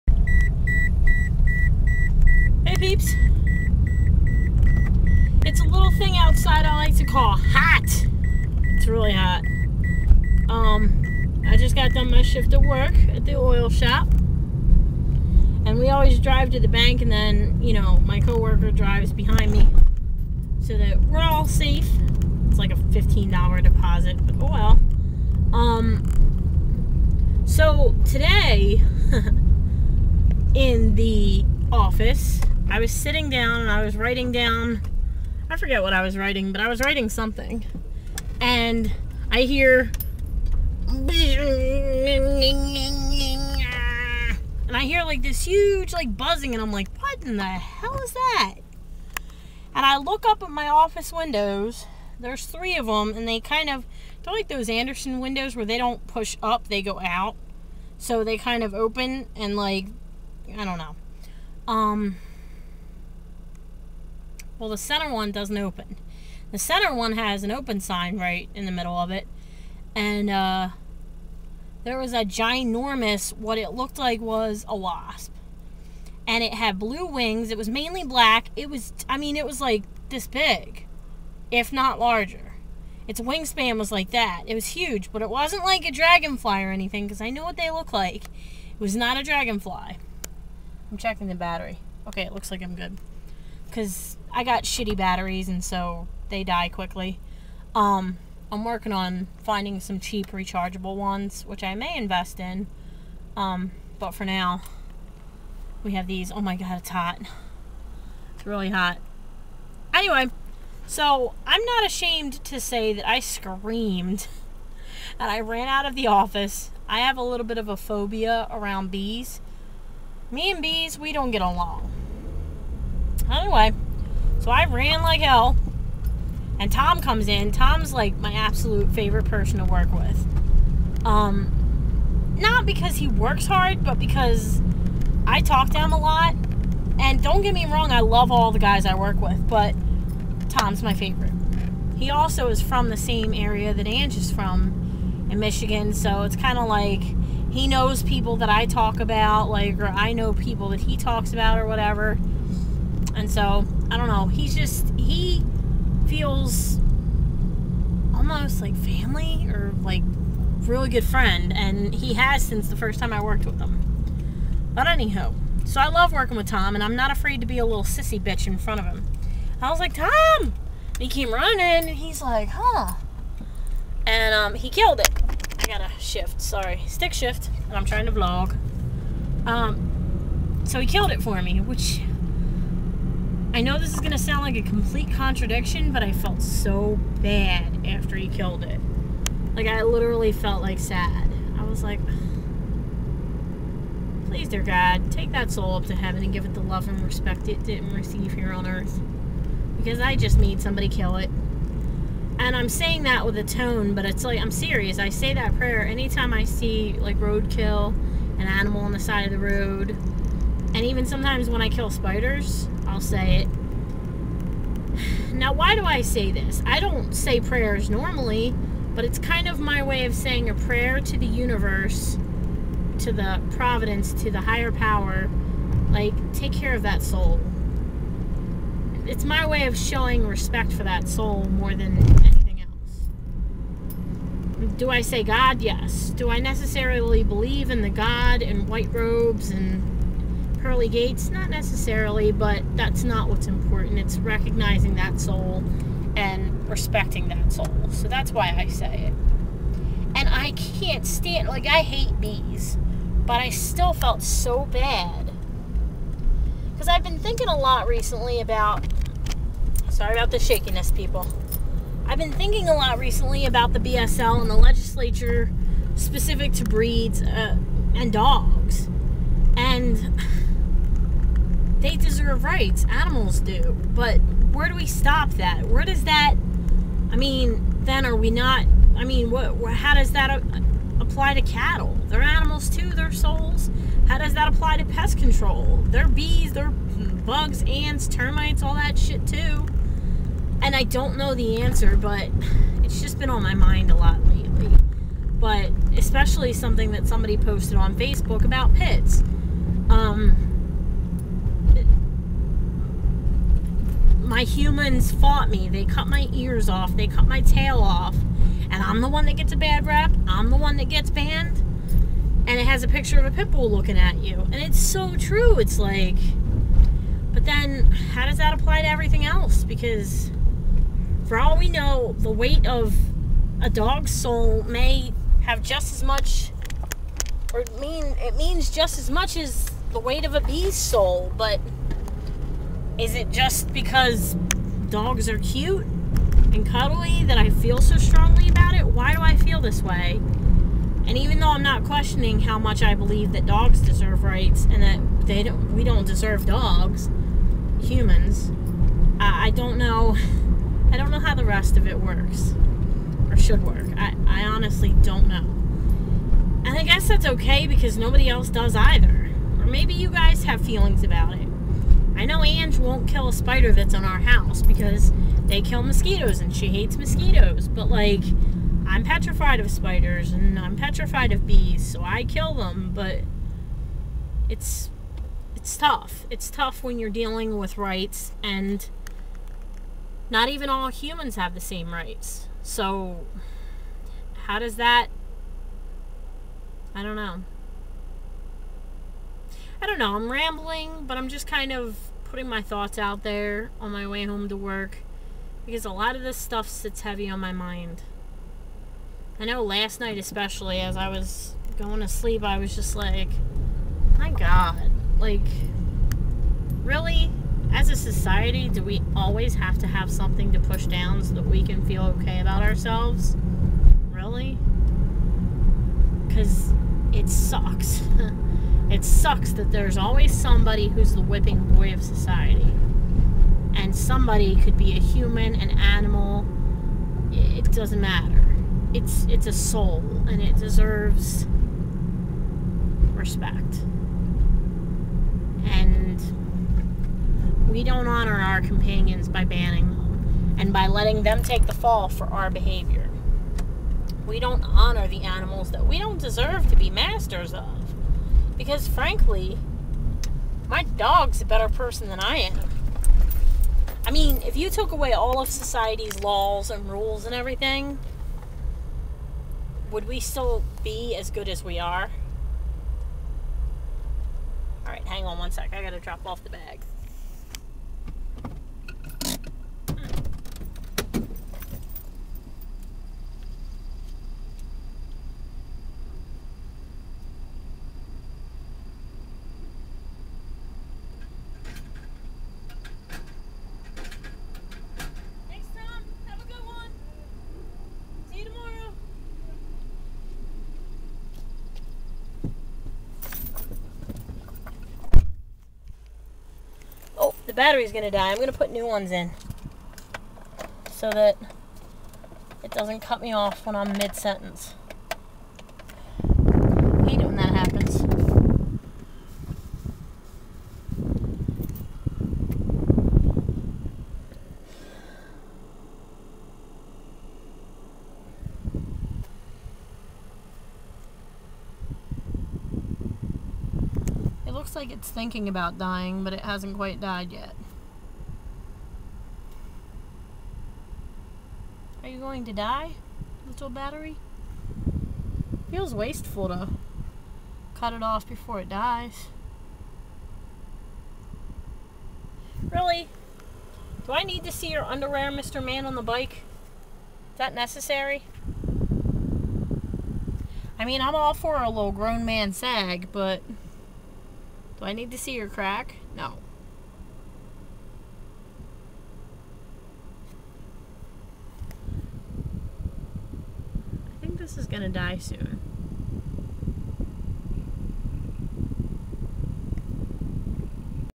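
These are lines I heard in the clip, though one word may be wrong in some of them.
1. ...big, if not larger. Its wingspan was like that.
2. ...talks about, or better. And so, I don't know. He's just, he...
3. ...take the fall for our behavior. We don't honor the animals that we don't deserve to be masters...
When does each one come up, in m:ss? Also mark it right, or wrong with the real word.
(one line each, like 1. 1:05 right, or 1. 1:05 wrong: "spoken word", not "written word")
1. 1:20 right
2. 2:30 wrong: "whatever", not "better"
3. 7:21 right.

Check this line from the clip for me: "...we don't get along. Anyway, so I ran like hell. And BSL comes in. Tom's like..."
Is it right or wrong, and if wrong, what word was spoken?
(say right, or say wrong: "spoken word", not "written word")
wrong: "Tom", not "BSL".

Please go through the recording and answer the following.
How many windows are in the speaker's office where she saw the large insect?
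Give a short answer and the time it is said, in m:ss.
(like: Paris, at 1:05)
3, at 0:52.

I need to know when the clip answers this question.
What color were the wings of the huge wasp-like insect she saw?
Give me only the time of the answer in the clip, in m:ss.
1:16.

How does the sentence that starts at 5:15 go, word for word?
It's like, but then how does that apply to everything else?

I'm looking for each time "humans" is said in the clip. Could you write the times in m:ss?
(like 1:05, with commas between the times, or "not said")
5:04, 5:47, 6:20, 7:04.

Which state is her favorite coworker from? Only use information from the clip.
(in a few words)
Michigan.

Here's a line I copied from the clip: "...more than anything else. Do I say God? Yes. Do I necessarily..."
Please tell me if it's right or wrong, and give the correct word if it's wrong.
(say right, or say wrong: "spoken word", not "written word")
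right.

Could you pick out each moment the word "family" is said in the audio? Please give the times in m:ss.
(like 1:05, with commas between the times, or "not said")
2:38.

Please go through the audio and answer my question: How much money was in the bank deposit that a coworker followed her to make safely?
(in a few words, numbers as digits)
$15.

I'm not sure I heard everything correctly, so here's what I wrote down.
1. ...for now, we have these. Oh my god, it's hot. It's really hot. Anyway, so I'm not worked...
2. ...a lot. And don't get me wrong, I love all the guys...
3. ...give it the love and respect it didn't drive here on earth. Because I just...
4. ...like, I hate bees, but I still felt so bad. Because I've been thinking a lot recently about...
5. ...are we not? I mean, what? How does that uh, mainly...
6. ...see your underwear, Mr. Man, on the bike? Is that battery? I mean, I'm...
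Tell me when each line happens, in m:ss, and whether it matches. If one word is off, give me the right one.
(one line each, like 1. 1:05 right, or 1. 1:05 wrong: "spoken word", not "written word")
1. 1:44 wrong: "ashamed", not "worked"
2. 2:15 right
3. 3:16 wrong: "receive", not "drive"
4. 4:11 right
5. 4:38 wrong: "apply", not "mainly"
6. 9:04 wrong: "necessary", not "battery".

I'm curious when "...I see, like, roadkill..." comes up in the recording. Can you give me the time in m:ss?
3:26.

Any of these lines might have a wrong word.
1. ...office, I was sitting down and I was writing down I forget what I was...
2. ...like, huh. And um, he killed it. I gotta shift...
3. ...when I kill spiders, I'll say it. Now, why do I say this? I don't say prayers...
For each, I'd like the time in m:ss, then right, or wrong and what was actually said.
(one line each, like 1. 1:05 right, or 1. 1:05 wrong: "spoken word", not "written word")
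1. 0:31 right
2. 2:52 right
3. 3:31 right.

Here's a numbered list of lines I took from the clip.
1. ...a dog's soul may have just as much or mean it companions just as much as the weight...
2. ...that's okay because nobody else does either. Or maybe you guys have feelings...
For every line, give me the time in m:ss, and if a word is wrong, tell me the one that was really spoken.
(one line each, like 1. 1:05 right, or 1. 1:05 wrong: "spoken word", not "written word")
1. 5:23 wrong: "means", not "companions"
2. 5:57 right.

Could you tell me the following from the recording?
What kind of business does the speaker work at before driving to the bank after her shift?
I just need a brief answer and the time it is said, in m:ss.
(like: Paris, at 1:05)
oil shop, at 0:13.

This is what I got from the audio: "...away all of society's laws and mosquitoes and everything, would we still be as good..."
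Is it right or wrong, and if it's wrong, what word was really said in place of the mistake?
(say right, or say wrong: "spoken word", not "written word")
wrong: "rules", not "mosquitoes".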